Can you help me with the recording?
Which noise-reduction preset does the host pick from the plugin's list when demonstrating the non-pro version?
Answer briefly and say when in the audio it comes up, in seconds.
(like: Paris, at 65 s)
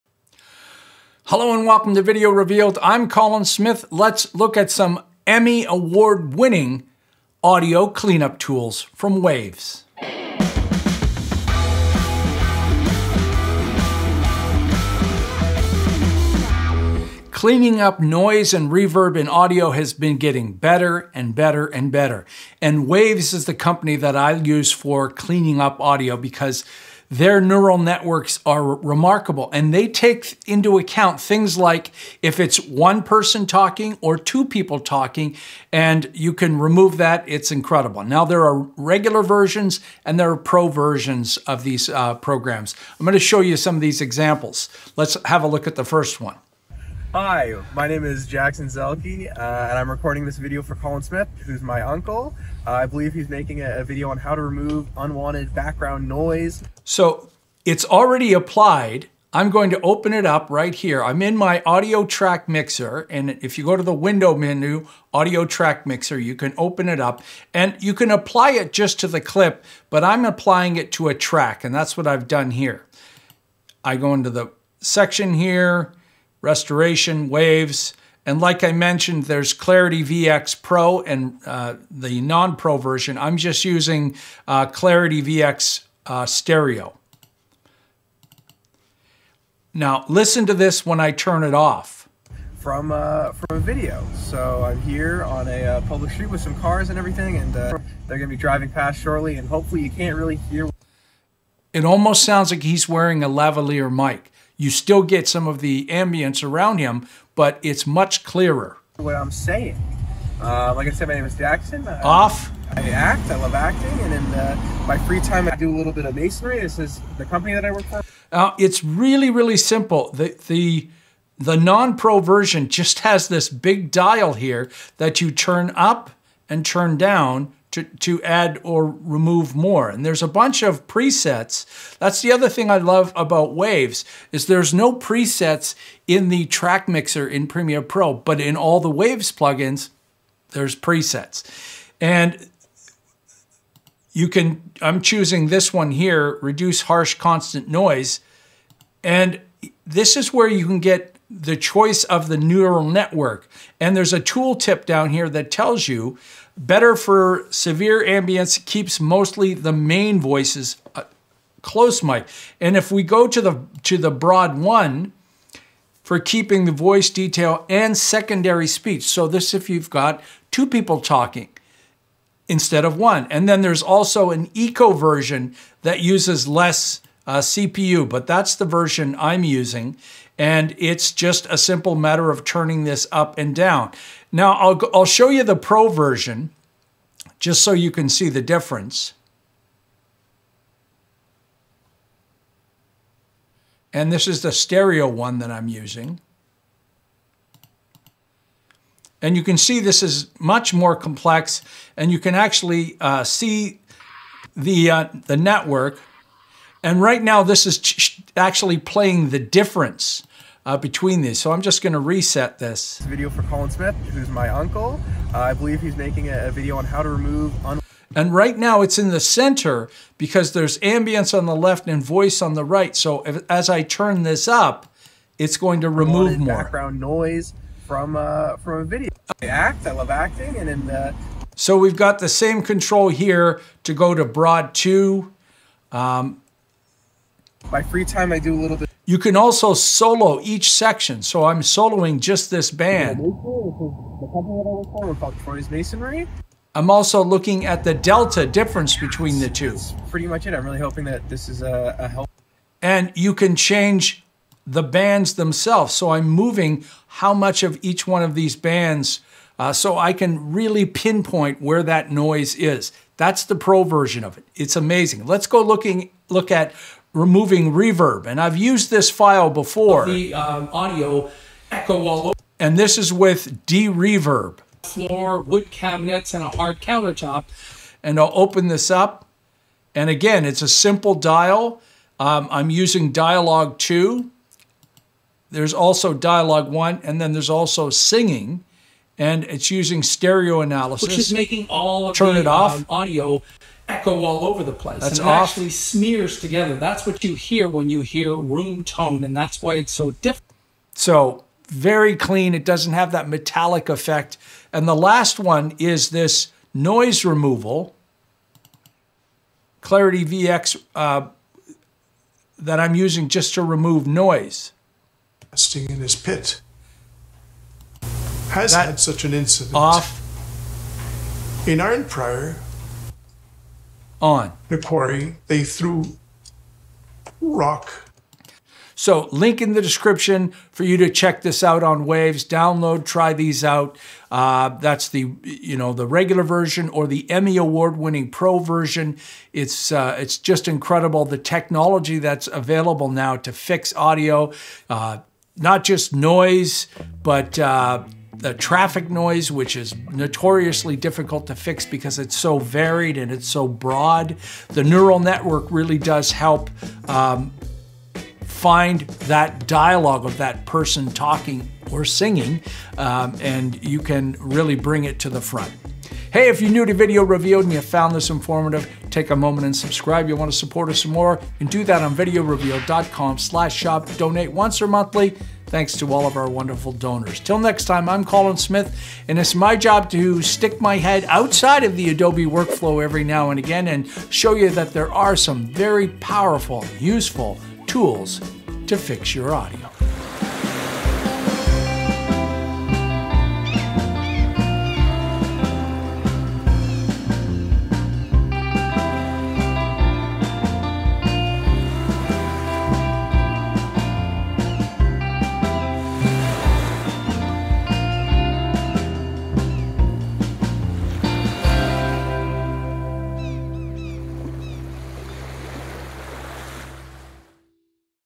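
reduce harsh constant noise, at 146 s.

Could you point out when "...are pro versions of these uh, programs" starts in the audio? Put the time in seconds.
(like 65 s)
40 s.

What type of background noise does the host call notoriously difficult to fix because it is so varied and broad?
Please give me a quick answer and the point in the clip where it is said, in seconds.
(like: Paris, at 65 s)
traffic noise, at 348 s.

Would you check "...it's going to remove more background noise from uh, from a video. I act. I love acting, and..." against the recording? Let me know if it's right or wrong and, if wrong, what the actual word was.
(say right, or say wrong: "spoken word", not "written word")
right.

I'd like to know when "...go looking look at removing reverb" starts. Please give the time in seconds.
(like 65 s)
265 s.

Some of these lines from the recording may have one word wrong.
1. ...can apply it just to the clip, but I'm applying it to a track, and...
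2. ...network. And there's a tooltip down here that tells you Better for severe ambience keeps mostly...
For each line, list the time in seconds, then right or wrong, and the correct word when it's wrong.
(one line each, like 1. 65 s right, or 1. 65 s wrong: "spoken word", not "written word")
1. 67 s right
2. 152 s right.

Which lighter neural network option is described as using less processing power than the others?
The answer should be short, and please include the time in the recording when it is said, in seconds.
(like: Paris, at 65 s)
eco, at 174 s.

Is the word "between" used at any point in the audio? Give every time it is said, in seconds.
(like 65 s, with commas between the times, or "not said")
210 s, 248 s.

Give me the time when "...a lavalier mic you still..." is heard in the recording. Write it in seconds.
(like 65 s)
103 s.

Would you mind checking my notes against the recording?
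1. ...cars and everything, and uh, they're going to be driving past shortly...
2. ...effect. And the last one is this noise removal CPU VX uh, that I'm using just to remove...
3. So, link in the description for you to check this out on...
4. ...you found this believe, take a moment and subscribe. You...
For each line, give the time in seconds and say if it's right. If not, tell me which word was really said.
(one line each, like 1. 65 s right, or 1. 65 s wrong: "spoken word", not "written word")
1. 96 s right
2. 303 s wrong: "Clarity", not "CPU"
3. 328 s right
4. 367 s wrong: "informative", not "believe".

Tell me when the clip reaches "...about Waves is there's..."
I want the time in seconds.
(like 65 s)
133 s.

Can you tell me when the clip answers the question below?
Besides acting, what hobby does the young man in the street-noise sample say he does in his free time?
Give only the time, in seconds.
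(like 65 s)
116 s.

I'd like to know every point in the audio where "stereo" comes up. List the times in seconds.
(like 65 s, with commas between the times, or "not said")
86 s, 194 s, 290 s.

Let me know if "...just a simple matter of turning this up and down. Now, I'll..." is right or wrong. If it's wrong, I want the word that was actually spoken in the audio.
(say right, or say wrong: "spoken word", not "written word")
right.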